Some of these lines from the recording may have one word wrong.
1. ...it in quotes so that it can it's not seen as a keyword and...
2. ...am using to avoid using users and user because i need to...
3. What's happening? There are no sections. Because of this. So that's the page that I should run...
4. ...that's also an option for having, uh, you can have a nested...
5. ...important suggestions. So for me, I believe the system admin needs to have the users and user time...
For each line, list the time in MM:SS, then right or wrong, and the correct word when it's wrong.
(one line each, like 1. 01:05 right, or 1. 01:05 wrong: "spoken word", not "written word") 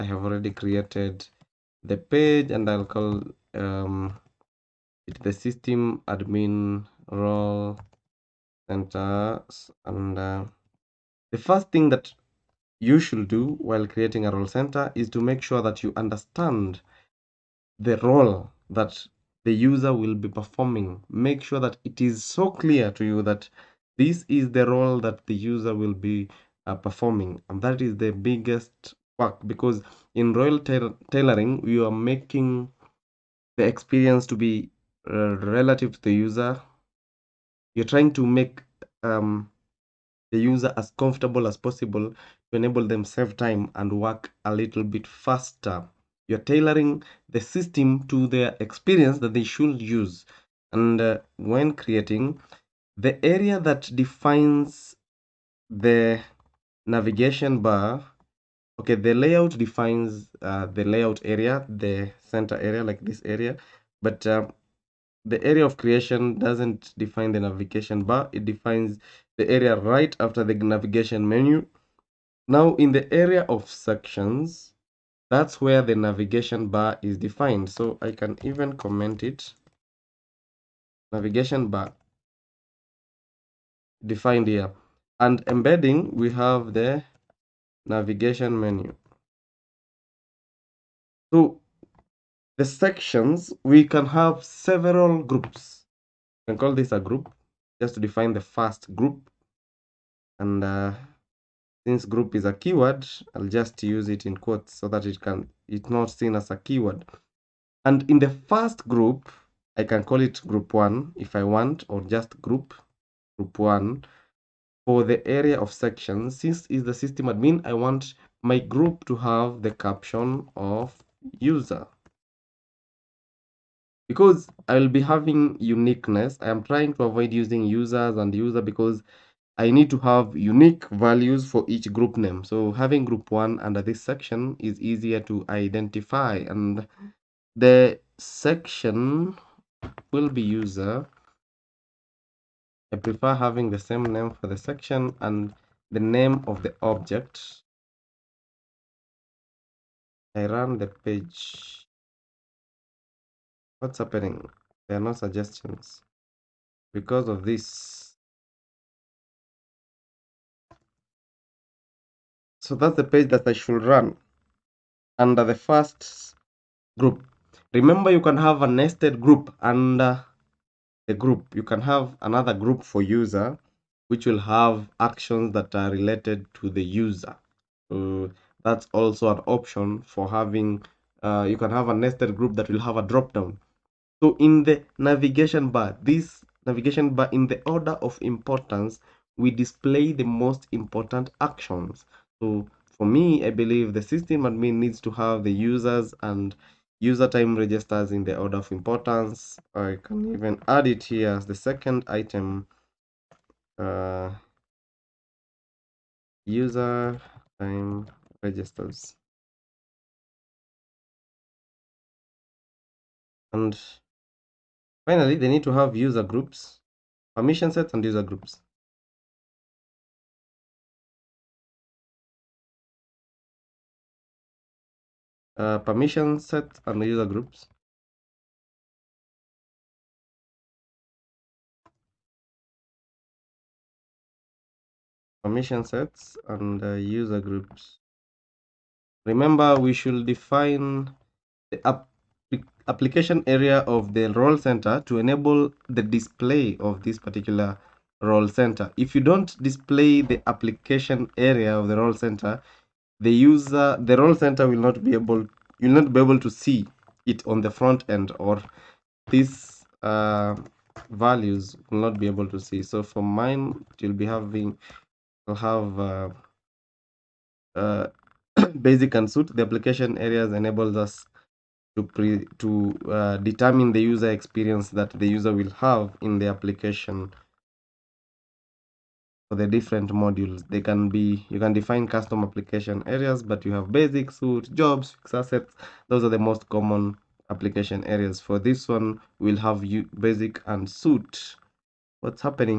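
1. 01:44 right
2. 02:06 wrong: "trying", not "using"
3. 02:33 wrong: "suggestions", not "sections"
4. 02:58 right
5. 03:10 wrong: "actions", not "suggestions".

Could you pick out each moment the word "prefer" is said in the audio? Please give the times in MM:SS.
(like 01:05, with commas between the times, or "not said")
02:22.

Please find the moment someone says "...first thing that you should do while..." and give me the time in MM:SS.
00:11.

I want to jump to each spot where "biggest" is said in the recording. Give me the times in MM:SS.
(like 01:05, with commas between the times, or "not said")
00:28.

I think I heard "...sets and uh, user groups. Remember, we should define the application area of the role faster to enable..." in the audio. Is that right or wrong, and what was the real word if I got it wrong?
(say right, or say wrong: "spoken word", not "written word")
wrong: "center", not "faster".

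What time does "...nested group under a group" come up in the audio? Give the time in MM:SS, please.
02:48.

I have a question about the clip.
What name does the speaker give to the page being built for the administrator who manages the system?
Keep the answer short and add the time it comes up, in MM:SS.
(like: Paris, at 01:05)
System admin role center, at 00:05.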